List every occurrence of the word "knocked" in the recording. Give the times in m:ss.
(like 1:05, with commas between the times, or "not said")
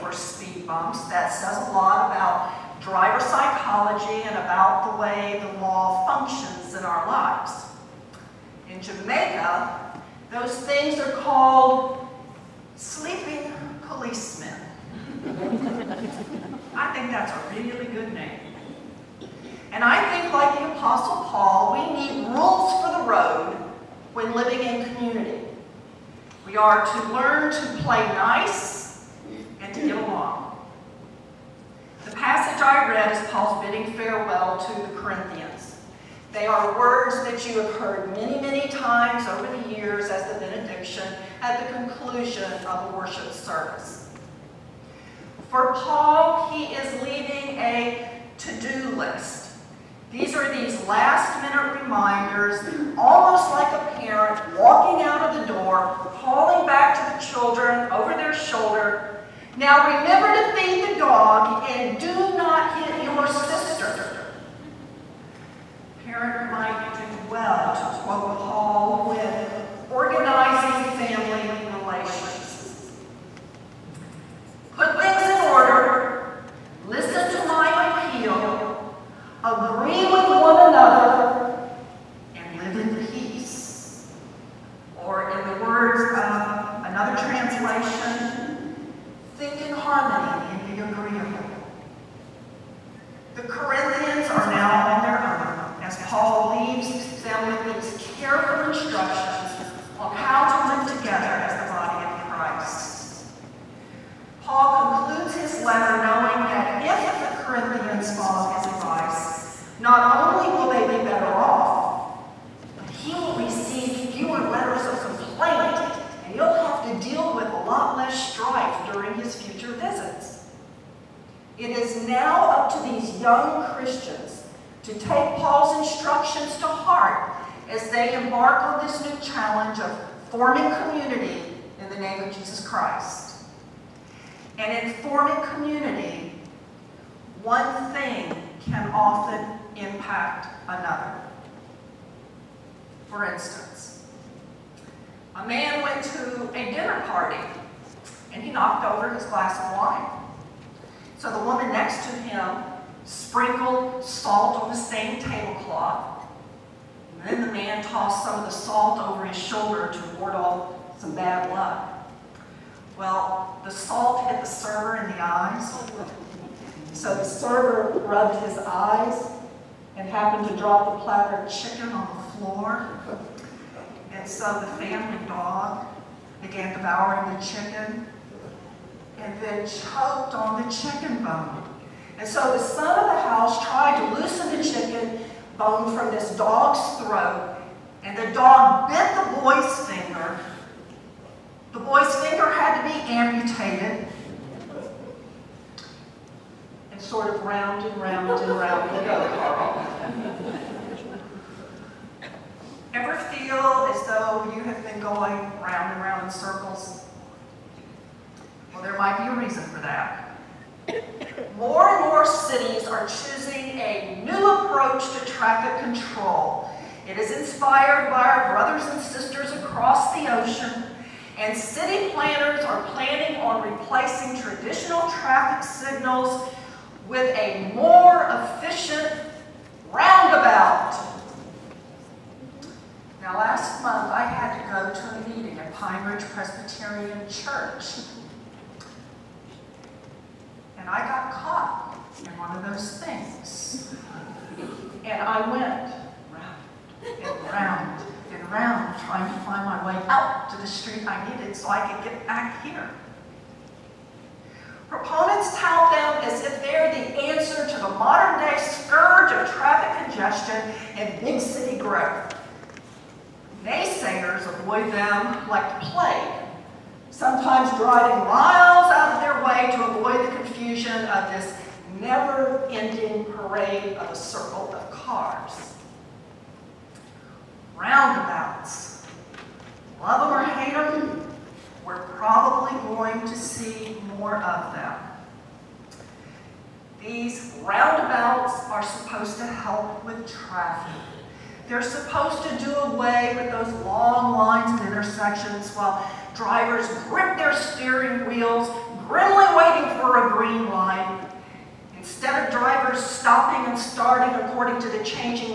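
2:28.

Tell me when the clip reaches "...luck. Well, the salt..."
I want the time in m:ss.
2:41.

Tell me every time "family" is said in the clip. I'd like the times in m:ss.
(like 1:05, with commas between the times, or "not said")
1:10, 2:54.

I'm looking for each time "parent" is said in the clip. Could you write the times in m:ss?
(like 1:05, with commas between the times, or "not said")
0:53, 1:06.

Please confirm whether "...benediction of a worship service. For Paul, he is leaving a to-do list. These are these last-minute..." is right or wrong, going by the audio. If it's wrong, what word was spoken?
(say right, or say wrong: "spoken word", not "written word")
wrong: "conclusion", not "benediction".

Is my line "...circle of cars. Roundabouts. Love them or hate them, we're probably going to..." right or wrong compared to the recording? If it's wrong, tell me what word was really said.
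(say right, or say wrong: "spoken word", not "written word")
right.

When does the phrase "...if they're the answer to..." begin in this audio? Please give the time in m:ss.
4:16.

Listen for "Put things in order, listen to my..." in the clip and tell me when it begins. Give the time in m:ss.
1:14.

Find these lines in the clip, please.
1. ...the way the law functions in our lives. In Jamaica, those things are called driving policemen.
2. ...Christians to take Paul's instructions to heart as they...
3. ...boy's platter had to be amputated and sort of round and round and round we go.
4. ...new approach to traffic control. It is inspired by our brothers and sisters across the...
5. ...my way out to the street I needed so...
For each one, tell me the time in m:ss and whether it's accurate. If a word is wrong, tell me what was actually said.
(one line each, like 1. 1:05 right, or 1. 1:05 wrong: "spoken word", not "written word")
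1. 0:04 wrong: "sleeping", not "driving"
2. 2:03 right
3. 3:11 wrong: "finger", not "platter"
4. 3:34 right
5. 4:09 right.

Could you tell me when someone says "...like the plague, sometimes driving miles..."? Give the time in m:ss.
4:25.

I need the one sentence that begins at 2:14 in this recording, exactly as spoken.
And in forming community, one thing can often impact another.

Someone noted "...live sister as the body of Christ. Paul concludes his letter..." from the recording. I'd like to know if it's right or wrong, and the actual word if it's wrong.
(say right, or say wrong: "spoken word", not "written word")
wrong: "together", not "sister".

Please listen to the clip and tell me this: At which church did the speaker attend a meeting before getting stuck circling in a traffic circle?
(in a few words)
Pine Ridge Presbyterian Church.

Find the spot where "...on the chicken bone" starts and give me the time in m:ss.
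3:00.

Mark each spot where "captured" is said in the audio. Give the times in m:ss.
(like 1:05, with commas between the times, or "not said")
not said.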